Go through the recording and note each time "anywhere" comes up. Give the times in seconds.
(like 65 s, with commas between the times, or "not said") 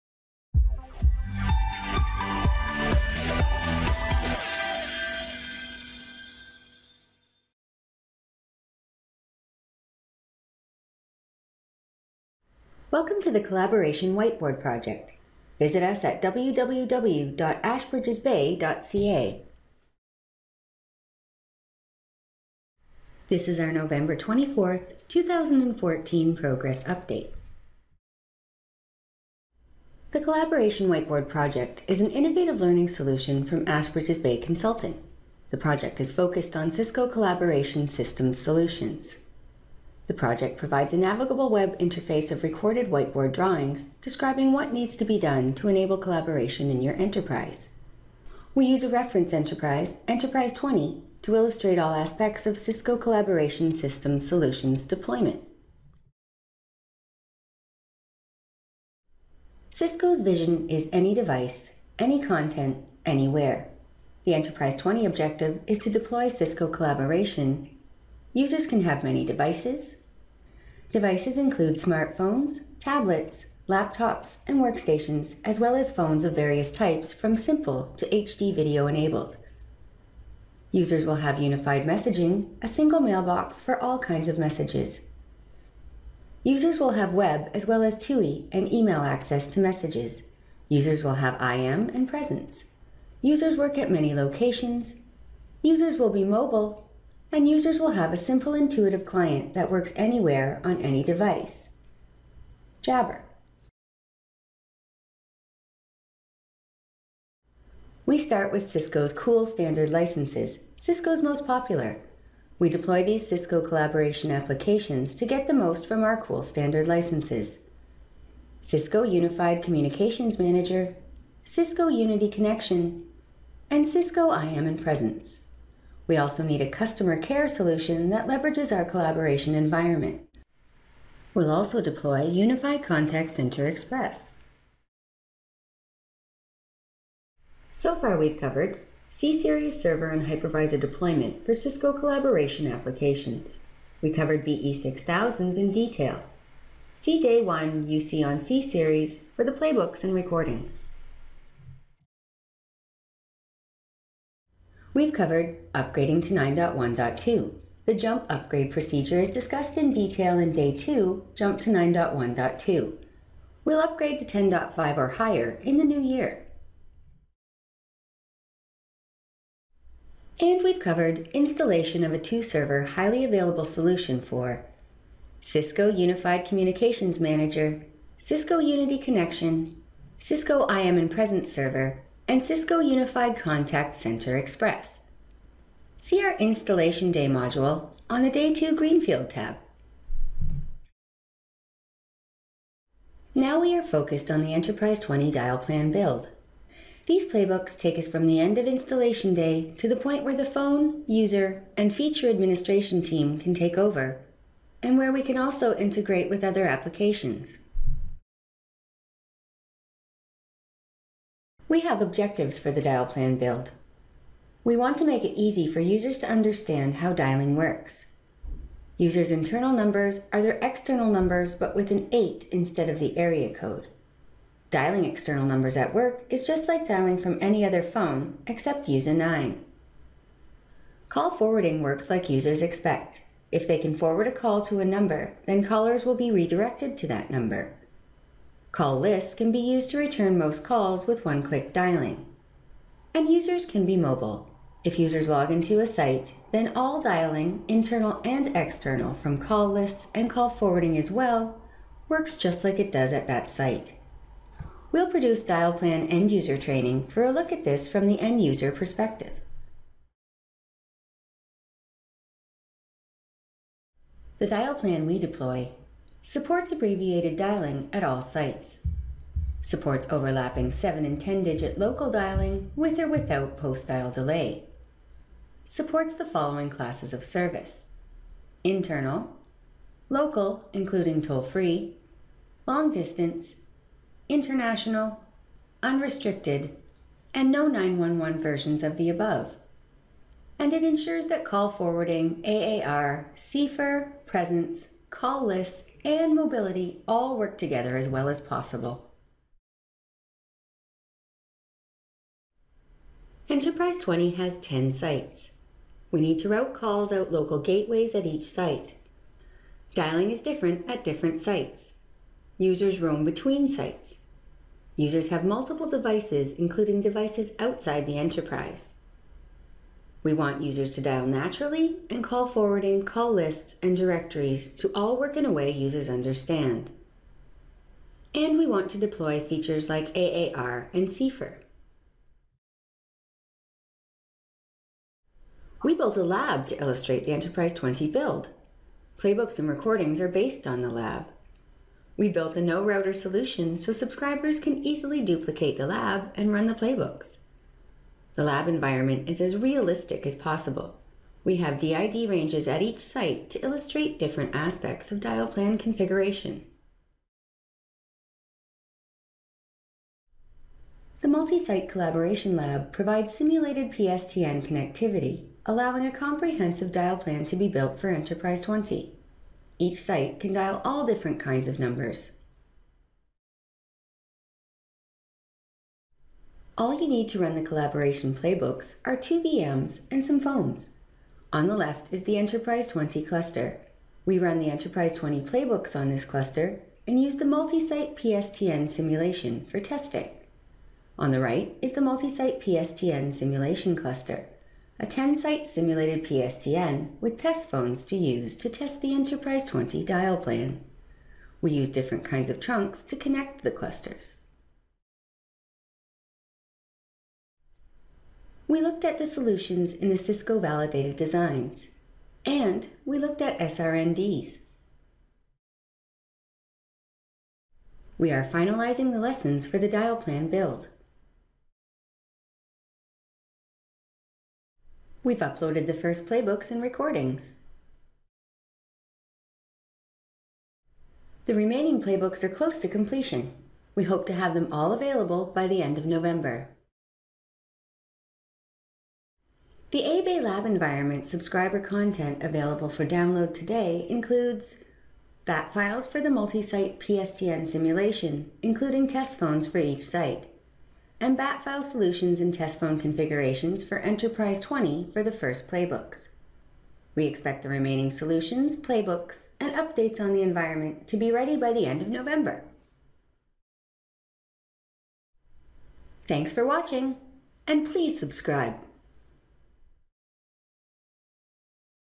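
63 s, 99 s.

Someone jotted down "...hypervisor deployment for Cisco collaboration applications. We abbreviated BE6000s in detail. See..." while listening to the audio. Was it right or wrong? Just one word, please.
wrong.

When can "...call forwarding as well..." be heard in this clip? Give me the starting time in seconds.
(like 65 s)
250 s.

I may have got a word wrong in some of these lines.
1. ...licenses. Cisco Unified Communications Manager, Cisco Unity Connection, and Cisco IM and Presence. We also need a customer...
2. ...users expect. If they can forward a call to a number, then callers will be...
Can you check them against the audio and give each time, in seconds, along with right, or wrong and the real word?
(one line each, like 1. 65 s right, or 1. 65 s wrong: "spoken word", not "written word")
1. 116 s right
2. 232 s right.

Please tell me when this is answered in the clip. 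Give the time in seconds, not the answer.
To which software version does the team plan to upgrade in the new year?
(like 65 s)
164 s.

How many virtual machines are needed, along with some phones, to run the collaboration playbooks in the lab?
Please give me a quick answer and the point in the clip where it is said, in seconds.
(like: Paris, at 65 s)
2, at 379 s.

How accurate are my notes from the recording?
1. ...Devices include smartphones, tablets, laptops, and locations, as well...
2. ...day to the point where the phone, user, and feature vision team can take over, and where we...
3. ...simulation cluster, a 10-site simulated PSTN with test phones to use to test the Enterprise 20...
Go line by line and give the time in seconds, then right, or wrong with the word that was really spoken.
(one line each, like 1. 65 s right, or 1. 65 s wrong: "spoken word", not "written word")
1. 70 s wrong: "workstations", not "locations"
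2. 199 s wrong: "administration", not "vision"
3. 393 s right.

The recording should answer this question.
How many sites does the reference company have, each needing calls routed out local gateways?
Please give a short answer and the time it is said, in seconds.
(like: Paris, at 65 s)
10, at 304 s.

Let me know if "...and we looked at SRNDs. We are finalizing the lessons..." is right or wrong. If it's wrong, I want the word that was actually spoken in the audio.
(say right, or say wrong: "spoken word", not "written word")
right.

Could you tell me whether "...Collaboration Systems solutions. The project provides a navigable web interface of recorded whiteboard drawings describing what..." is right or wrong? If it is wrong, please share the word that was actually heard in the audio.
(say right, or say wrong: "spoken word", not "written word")
right.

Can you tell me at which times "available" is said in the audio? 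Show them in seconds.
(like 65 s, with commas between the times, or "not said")
173 s, 434 s, 442 s.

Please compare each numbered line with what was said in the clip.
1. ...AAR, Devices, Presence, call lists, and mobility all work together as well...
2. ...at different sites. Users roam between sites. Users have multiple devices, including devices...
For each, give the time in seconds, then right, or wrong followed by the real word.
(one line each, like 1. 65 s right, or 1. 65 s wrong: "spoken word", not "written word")
1. 292 s wrong: "CFUR", not "Devices"
2. 310 s right.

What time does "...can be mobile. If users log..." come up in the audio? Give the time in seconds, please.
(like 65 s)
243 s.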